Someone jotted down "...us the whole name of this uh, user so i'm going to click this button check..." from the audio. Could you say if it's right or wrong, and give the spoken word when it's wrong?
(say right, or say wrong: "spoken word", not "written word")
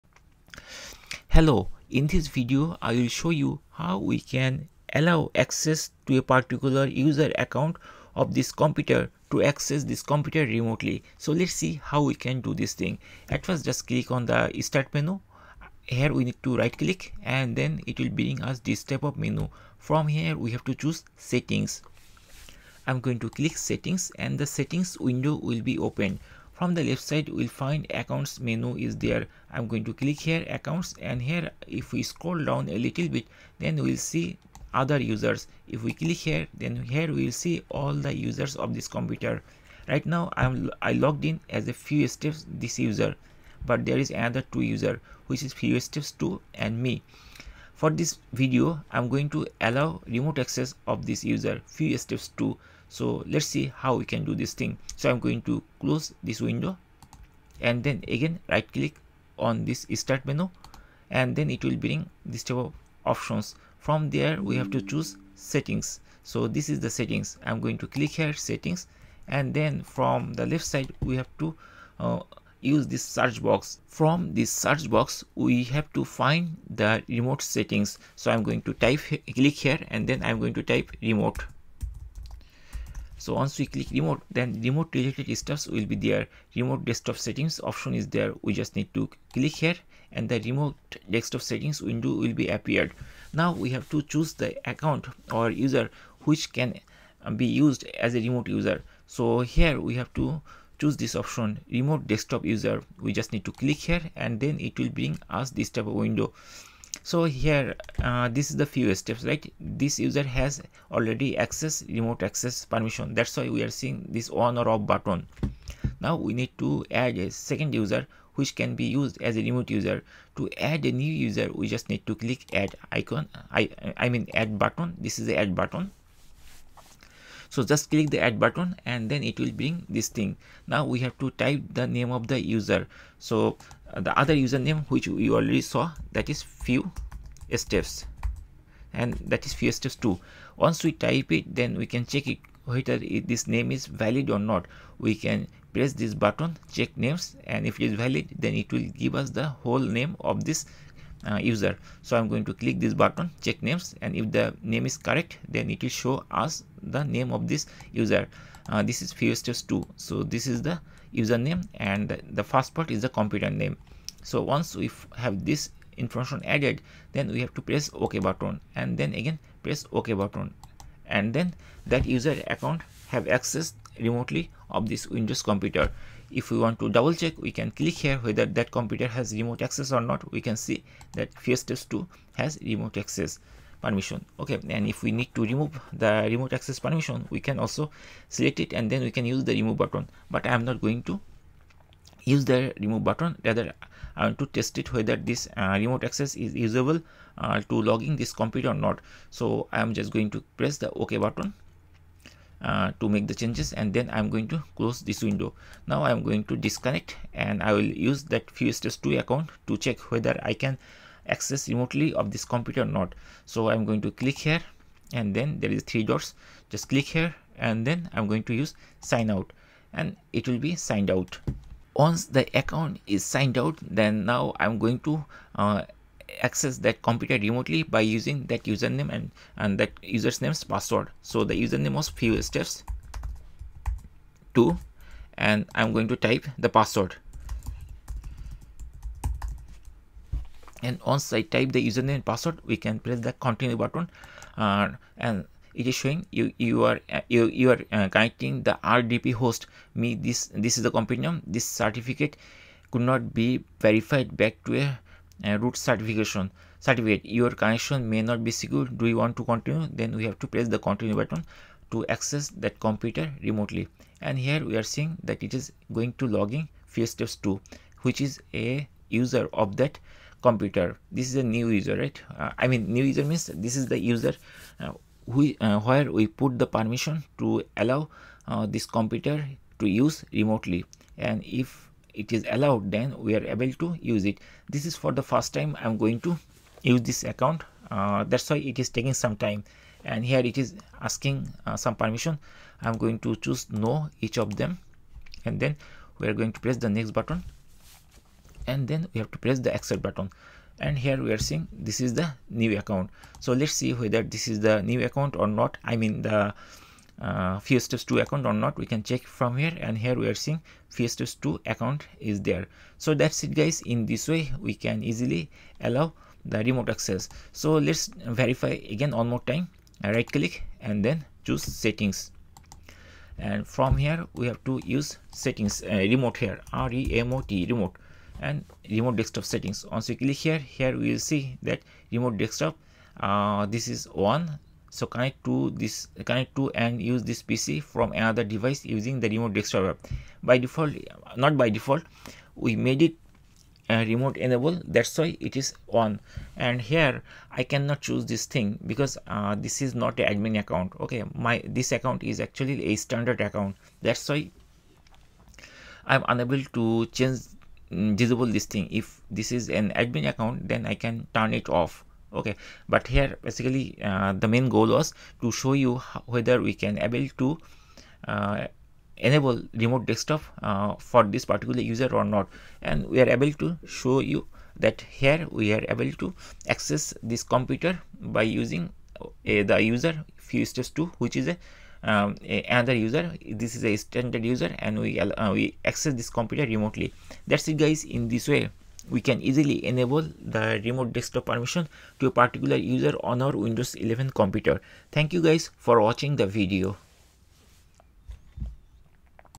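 right.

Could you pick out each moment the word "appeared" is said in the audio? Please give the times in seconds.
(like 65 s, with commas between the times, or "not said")
92 s.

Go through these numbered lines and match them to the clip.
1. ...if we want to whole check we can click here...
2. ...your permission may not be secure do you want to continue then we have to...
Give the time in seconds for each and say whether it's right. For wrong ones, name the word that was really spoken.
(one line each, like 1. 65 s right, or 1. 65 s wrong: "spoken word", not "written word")
1. 176 s wrong: "double", not "whole"
2. 257 s wrong: "connection", not "permission".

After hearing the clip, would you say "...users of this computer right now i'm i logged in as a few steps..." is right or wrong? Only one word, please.
right.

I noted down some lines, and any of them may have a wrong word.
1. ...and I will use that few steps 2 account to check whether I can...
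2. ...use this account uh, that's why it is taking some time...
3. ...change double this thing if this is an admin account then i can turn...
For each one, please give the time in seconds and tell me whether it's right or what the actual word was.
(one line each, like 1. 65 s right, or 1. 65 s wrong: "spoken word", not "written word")
1. 207 s right
2. 286 s right
3. 357 s wrong: "disable", not "double".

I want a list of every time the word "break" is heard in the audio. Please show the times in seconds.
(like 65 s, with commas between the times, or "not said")
not said.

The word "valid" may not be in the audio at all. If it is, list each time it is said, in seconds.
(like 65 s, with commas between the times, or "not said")
143 s, 147 s.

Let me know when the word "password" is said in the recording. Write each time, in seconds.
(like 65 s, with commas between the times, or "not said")
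230 s, 236 s, 242 s.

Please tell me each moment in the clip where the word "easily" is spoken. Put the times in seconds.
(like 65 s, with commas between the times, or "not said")
315 s, 389 s.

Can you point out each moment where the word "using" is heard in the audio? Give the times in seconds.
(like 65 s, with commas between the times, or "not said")
227 s, 338 s, 378 s.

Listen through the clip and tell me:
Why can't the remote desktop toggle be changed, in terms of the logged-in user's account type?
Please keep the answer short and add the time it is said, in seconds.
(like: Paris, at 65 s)
standard account, at 352 s.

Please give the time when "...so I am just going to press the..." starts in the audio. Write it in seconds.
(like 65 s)
199 s.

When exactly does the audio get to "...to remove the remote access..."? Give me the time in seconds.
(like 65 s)
185 s.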